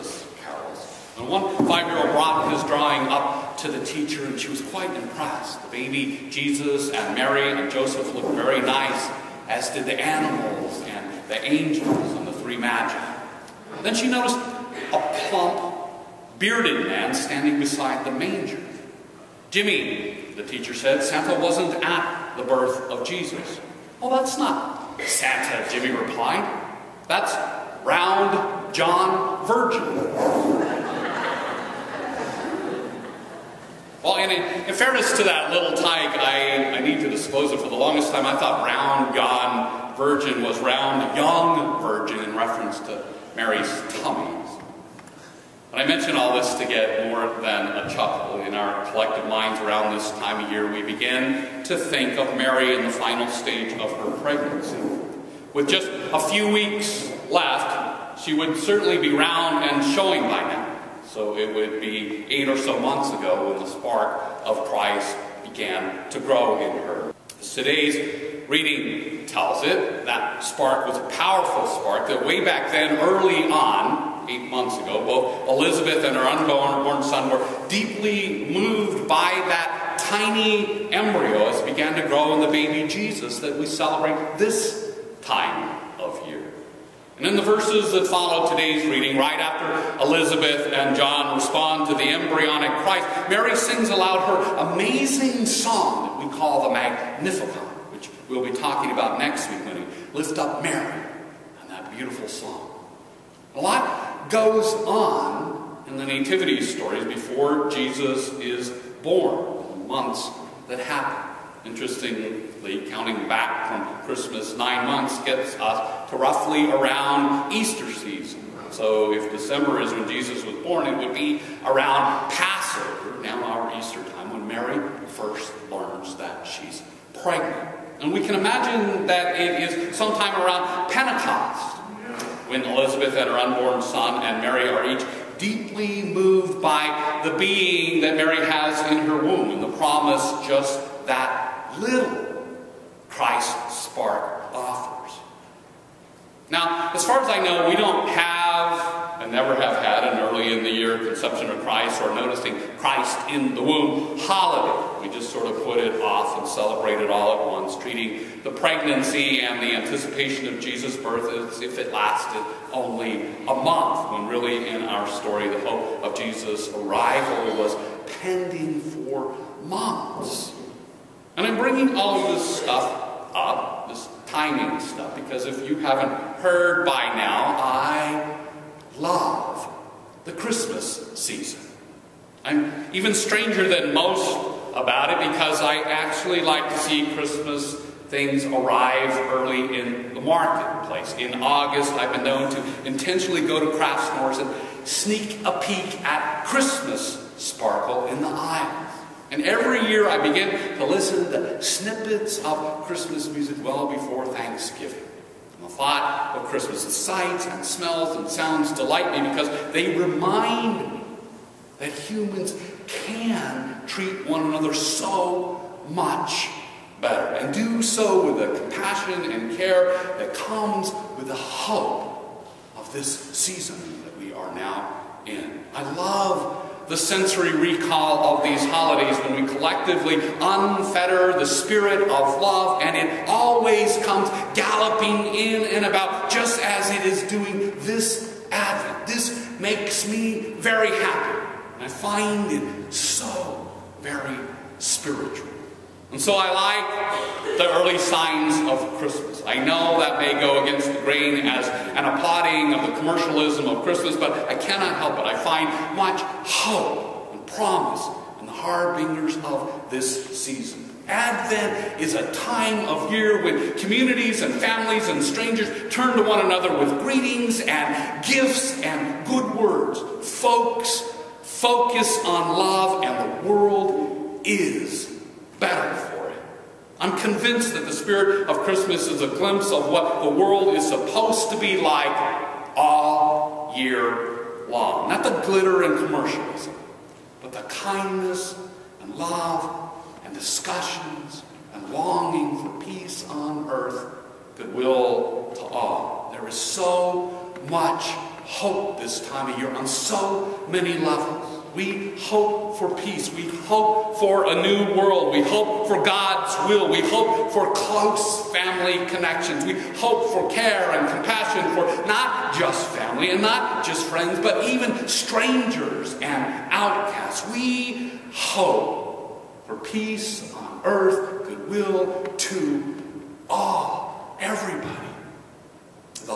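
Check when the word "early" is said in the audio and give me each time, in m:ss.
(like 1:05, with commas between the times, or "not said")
1:12, 2:30, 3:09, 4:07.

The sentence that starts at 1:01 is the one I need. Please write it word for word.
So it would be eight or so months ago when the spark of Christ began to grow in her.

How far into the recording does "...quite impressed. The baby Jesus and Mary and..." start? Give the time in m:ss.
0:04.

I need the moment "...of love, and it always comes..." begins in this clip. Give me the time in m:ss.
3:52.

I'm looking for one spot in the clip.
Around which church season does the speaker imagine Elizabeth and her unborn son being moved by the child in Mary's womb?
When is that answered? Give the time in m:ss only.
2:10.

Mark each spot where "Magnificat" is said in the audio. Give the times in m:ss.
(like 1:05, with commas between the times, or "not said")
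1:36.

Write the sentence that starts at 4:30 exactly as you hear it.
Folks, focus on love, and the world is battle for it.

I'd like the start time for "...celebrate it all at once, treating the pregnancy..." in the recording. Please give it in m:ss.
2:36.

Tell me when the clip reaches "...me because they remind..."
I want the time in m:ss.
3:29.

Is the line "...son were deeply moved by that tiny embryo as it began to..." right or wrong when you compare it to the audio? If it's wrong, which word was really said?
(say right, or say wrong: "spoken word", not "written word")
right.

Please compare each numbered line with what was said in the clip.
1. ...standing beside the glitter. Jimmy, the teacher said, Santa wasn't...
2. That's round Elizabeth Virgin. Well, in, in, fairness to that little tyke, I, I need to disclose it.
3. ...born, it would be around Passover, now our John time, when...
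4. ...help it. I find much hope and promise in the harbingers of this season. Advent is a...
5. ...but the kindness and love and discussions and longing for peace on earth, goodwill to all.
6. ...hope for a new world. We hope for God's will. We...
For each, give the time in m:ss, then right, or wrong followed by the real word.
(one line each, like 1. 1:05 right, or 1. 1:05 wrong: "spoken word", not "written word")
1. 0:17 wrong: "manger", not "glitter"
2. 0:27 wrong: "John", not "Elizabeth"
3. 2:00 wrong: "Easter", not "John"
4. 4:14 right
5. 4:47 right
6. 5:03 right.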